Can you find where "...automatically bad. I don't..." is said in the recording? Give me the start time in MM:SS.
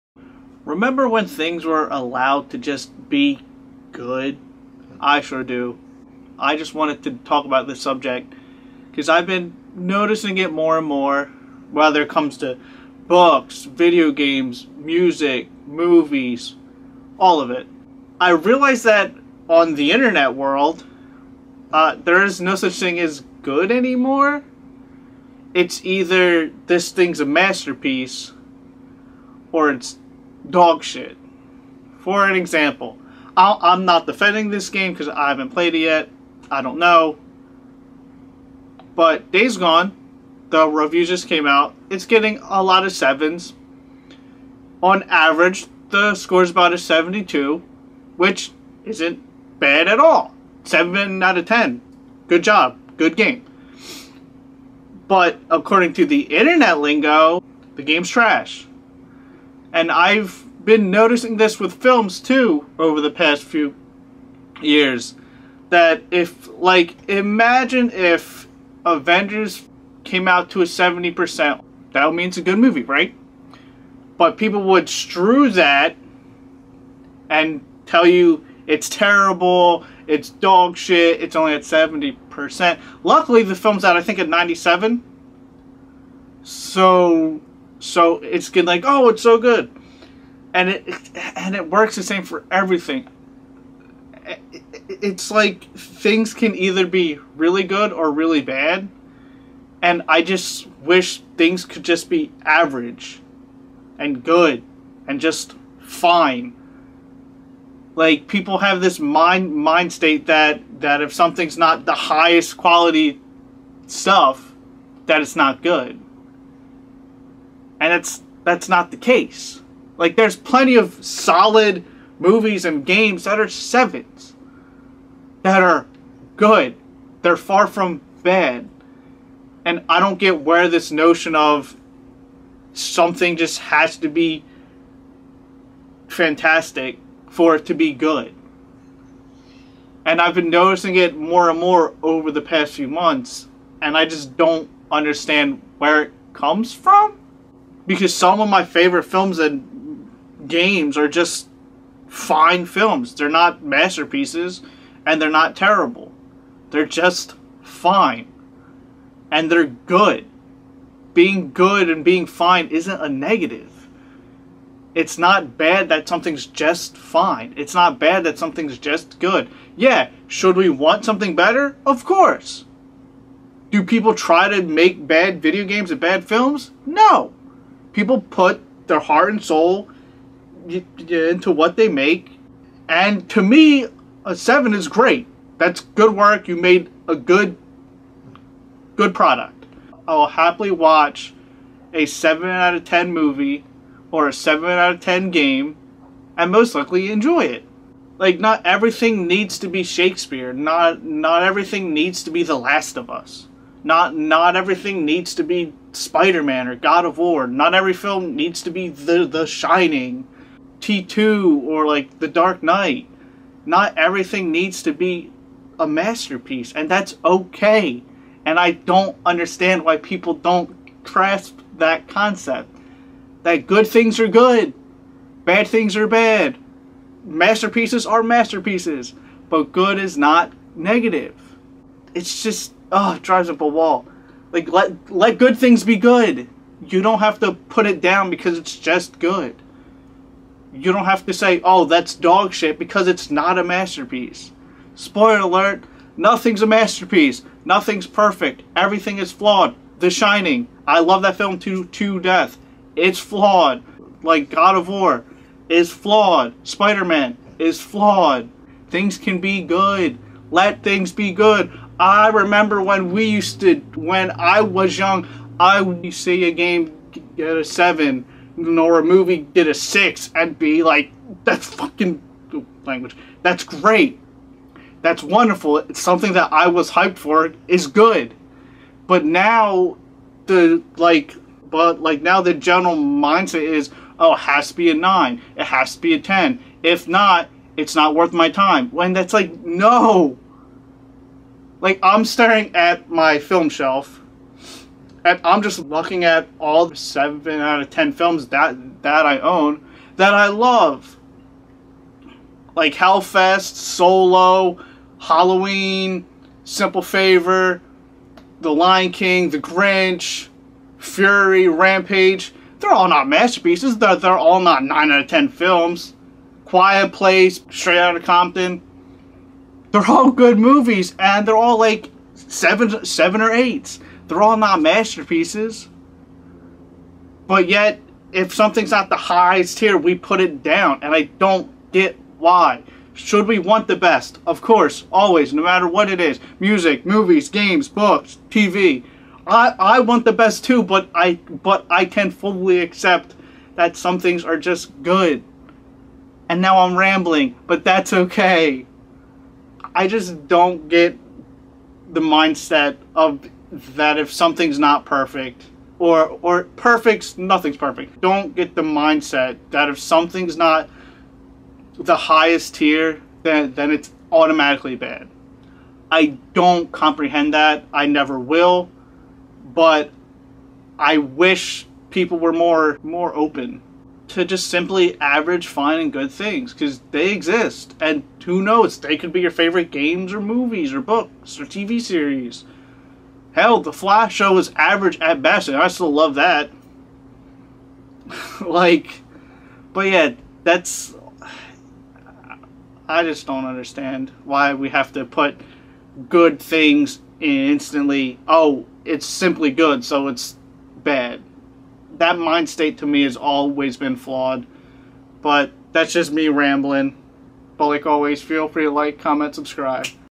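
06:04.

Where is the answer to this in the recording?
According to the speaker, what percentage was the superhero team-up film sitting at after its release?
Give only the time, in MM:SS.
01:24.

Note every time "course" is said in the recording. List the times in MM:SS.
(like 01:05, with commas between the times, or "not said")
02:52, 05:34.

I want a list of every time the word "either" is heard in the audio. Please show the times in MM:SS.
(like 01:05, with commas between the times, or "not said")
00:25, 01:36.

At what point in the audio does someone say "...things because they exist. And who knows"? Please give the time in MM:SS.
06:16.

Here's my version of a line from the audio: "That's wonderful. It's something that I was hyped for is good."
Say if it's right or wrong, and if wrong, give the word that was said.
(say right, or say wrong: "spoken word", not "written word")
right.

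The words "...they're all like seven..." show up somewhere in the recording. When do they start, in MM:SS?
05:21.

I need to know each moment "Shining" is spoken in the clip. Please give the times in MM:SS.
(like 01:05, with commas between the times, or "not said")
03:29, 04:10.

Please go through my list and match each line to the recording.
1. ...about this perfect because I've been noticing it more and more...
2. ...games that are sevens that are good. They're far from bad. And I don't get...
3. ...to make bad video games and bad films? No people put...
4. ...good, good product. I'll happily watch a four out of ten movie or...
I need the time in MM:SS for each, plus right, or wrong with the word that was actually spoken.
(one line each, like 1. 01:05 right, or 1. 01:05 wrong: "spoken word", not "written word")
1. 00:07 wrong: "subject", not "perfect"
2. 02:02 right
3. 02:54 right
4. 03:07 wrong: "seven", not "four".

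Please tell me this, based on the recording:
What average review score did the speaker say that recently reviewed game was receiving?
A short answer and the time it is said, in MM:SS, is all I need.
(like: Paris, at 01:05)
72, at 00:46.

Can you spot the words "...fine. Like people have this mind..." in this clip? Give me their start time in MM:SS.
01:45.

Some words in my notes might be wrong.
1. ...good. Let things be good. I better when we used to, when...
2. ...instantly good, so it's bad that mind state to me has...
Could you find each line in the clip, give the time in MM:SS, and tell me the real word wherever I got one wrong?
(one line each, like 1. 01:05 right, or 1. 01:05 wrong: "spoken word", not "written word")
1. 04:19 wrong: "remember", not "better"
2. 06:39 wrong: "simply", not "instantly".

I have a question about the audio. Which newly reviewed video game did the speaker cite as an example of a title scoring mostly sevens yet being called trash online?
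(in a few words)
Days Gone.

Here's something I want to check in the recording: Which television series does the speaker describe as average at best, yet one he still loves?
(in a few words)
The Flash.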